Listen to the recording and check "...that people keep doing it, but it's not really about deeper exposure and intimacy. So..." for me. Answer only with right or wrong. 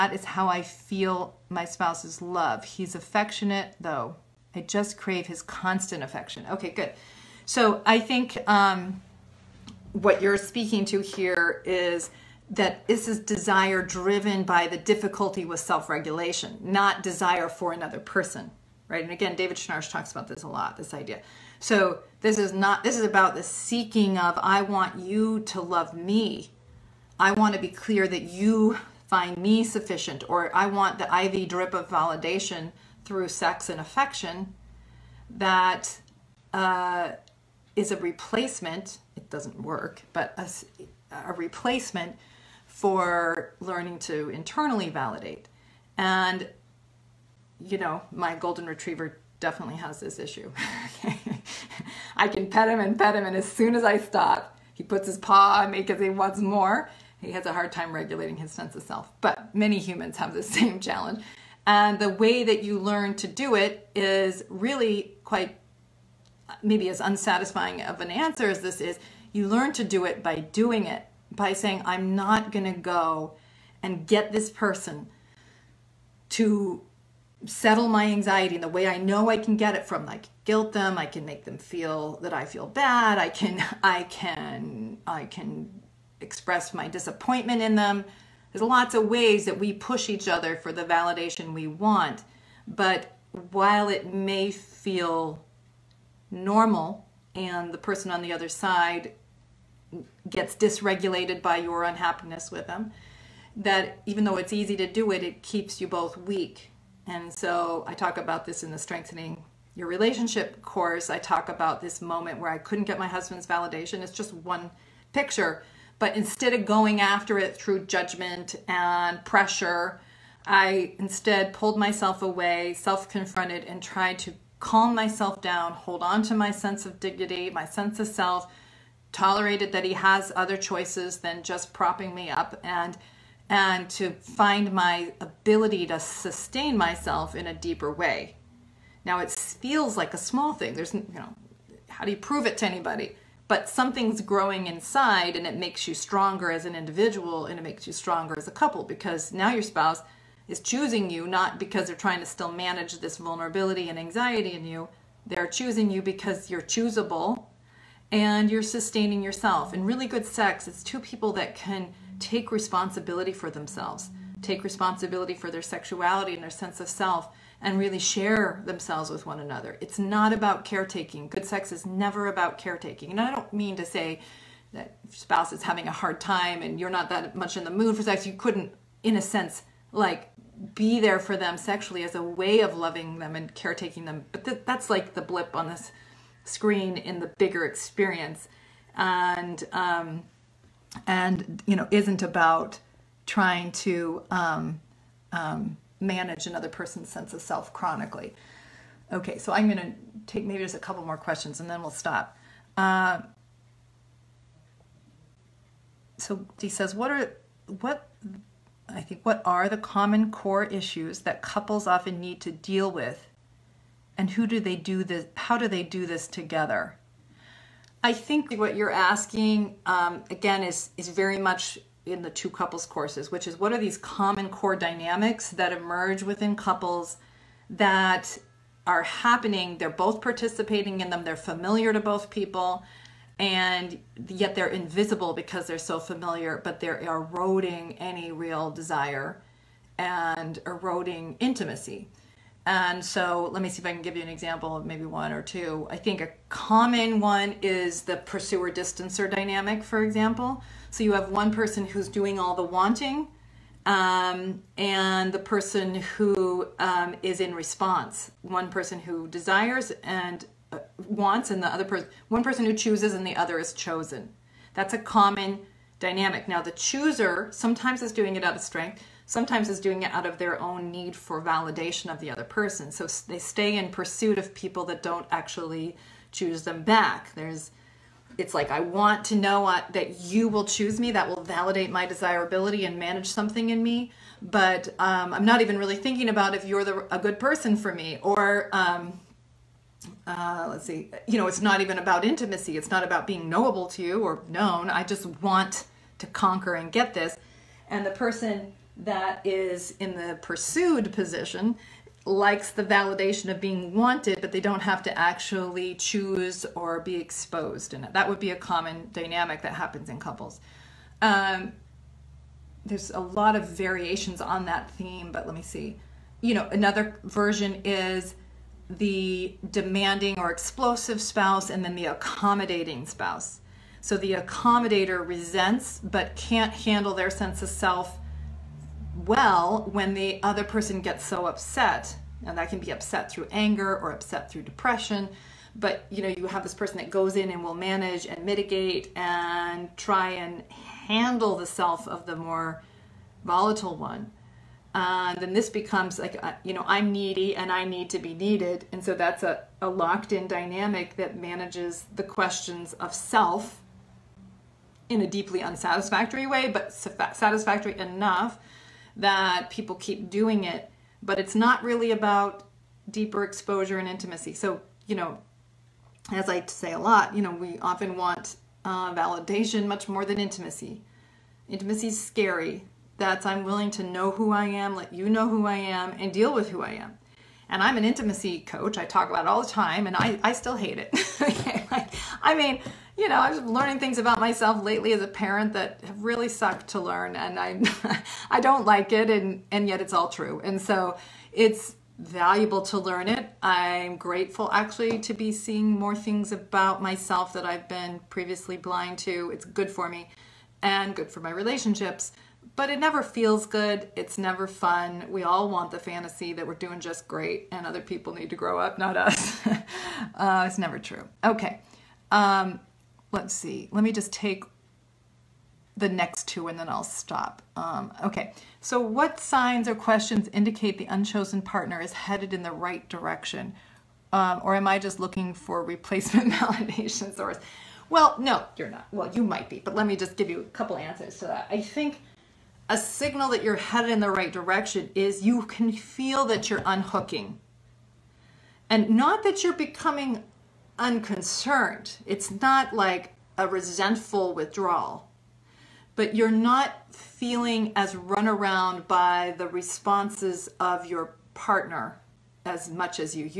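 right.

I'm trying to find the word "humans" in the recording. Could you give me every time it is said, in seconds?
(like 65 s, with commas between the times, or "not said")
59 s.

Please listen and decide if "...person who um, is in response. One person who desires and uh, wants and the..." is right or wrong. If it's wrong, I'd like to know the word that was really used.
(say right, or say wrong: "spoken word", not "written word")
right.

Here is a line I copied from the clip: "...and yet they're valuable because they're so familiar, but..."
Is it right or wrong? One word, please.
wrong.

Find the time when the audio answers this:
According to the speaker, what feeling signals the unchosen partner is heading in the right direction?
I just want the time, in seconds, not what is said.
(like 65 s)
436 s.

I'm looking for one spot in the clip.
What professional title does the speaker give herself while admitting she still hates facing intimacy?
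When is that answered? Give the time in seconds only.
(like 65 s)
378 s.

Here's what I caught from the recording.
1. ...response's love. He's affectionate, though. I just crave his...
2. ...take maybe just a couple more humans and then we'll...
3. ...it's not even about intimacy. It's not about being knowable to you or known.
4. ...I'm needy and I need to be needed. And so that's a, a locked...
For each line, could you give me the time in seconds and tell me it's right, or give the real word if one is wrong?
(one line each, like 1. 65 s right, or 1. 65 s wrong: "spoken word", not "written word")
1. 1 s wrong: "spouse", not "response"
2. 200 s wrong: "questions", not "humans"
3. 291 s right
4. 346 s right.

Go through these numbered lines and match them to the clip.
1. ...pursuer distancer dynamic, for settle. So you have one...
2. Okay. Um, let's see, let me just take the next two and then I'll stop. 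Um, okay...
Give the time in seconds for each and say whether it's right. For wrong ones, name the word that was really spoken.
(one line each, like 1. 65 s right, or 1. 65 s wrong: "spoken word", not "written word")
1. 248 s wrong: "example", not "settle"
2. 411 s right.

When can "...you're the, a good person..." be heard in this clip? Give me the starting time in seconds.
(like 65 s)
286 s.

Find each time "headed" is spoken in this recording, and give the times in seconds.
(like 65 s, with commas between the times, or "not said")
422 s, 433 s.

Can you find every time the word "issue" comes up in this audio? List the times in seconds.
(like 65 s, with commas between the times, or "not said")
50 s, 210 s.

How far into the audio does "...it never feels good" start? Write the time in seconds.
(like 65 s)
402 s.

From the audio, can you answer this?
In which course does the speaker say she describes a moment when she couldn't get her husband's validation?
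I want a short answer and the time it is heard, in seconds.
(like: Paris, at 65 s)
Strengthening Your Relationship, at 108 s.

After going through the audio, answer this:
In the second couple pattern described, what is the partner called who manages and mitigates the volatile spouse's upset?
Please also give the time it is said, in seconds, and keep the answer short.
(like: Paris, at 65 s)
accommodating spouse, at 322 s.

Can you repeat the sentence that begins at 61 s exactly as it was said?
And the way that you learn to do it is really quite maybe as unsatisfying of an answer as this is.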